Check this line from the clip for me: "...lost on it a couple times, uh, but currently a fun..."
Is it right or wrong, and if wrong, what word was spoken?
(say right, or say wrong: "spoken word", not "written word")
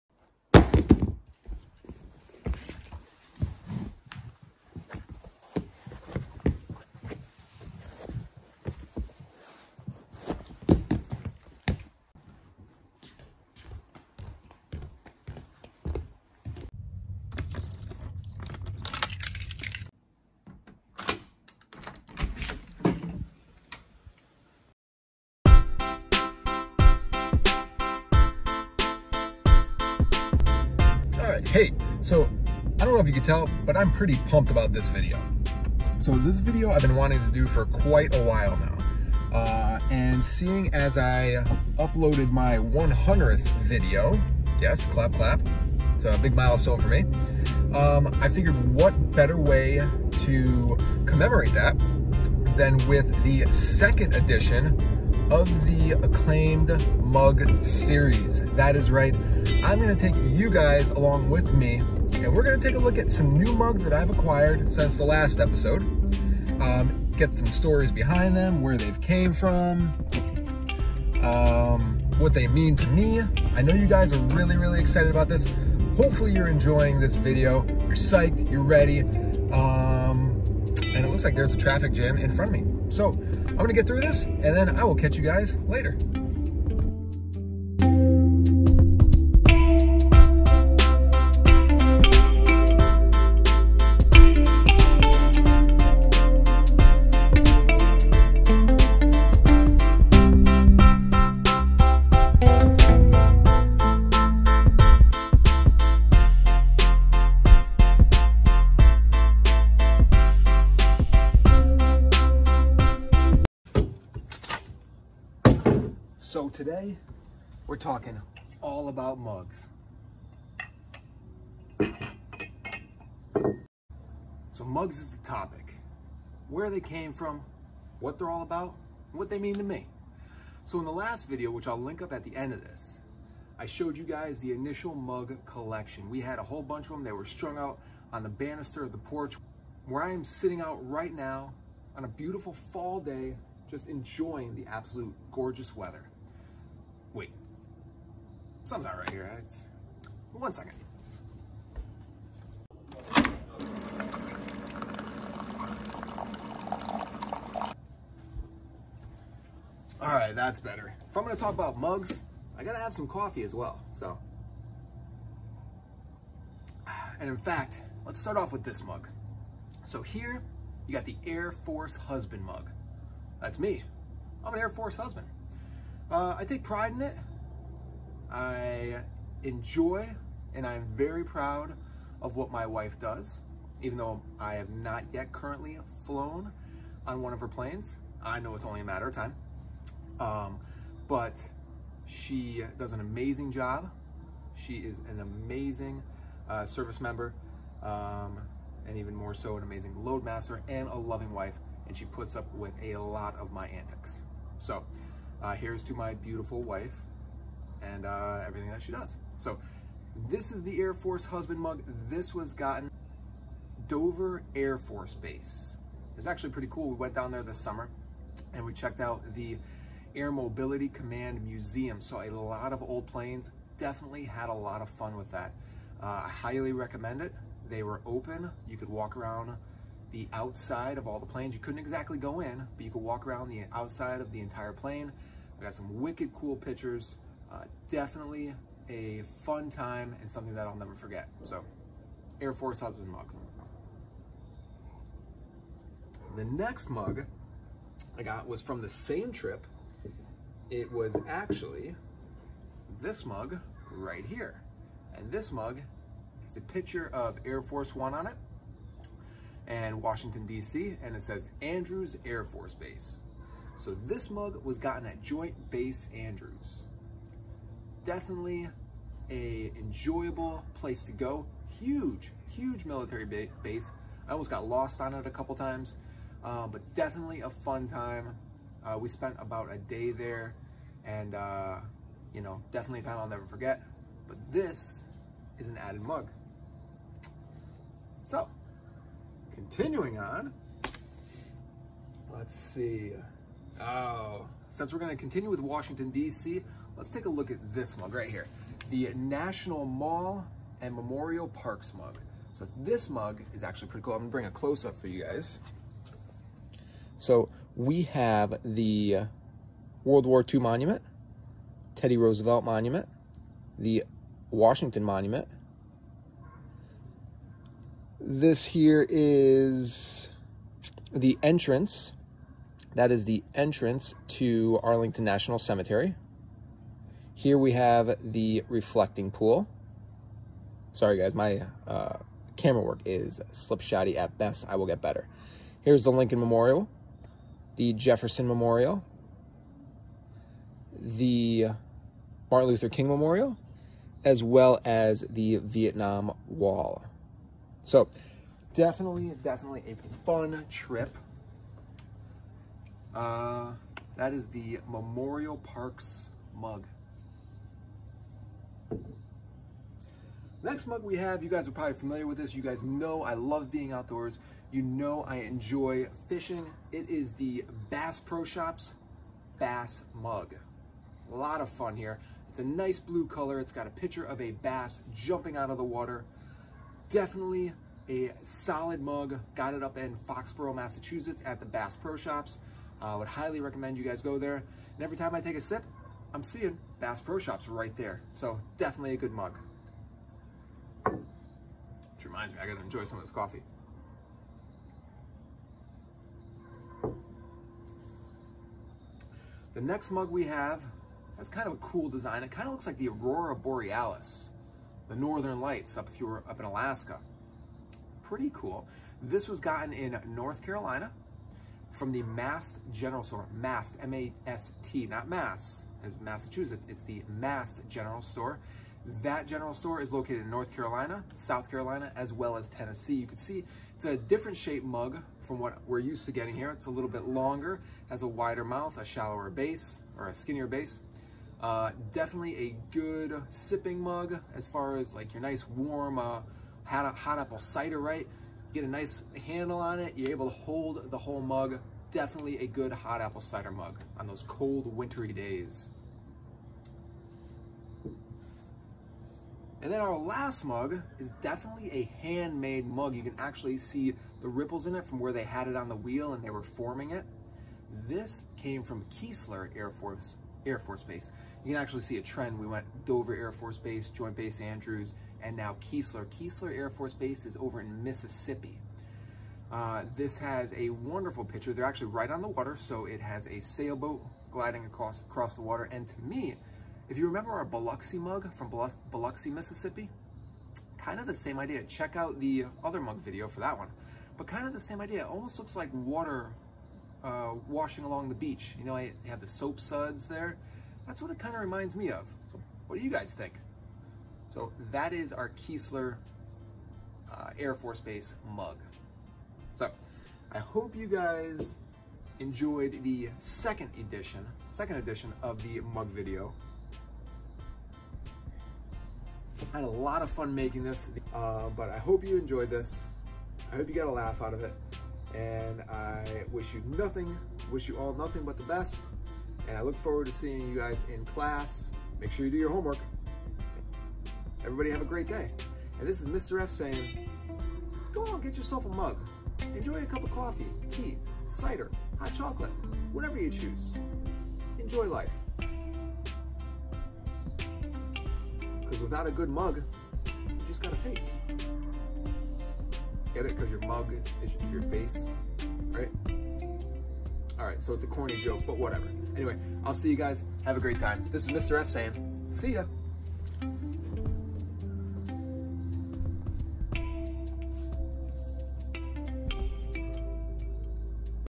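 wrong: "definitely", not "currently".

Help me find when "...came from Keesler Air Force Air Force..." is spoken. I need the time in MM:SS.
07:38.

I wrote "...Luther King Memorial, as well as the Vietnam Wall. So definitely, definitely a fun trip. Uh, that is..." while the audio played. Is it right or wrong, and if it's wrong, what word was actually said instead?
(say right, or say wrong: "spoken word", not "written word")
right.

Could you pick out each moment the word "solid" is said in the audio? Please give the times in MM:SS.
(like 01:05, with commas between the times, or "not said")
06:18.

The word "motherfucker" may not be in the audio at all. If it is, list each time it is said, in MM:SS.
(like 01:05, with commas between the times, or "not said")
not said.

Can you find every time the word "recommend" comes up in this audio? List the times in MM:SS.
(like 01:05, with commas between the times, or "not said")
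03:46, 06:23.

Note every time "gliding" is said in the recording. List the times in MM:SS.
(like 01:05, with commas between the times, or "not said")
07:54.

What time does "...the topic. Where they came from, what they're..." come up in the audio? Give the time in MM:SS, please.
02:05.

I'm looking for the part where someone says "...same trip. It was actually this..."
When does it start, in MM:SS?
04:08.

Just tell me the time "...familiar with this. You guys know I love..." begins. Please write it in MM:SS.
06:01.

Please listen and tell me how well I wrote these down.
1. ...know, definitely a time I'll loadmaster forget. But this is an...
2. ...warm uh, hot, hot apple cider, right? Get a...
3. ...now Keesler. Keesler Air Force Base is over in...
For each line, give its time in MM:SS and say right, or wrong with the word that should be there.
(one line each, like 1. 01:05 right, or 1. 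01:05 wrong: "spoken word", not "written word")
1. 04:42 wrong: "never", not "loadmaster"
2. 07:15 right
3. 07:45 right.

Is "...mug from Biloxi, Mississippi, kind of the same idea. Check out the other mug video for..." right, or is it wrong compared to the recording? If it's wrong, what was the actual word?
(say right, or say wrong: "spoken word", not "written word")
right.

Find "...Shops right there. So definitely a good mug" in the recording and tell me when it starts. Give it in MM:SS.
06:27.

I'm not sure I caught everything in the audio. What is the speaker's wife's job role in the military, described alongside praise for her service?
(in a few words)
Loadmaster.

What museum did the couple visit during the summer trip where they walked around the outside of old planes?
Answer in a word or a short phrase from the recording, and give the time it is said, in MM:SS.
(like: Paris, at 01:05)
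Air Mobility Command Museum, at 03:40.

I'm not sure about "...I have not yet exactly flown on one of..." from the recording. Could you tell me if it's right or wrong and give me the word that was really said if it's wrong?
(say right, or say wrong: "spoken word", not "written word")
wrong: "currently", not "exactly".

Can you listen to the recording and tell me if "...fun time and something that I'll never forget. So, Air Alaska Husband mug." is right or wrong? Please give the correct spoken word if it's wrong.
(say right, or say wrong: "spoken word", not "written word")
wrong: "Force", not "Alaska".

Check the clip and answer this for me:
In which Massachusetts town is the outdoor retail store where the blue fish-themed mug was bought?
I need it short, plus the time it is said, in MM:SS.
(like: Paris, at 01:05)
Foxborough, at 06:20.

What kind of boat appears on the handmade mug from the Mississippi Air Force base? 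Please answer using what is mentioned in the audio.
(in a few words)
Sailboat.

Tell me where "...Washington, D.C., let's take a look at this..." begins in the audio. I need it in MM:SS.
04:55.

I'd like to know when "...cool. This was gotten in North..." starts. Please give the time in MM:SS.
06:48.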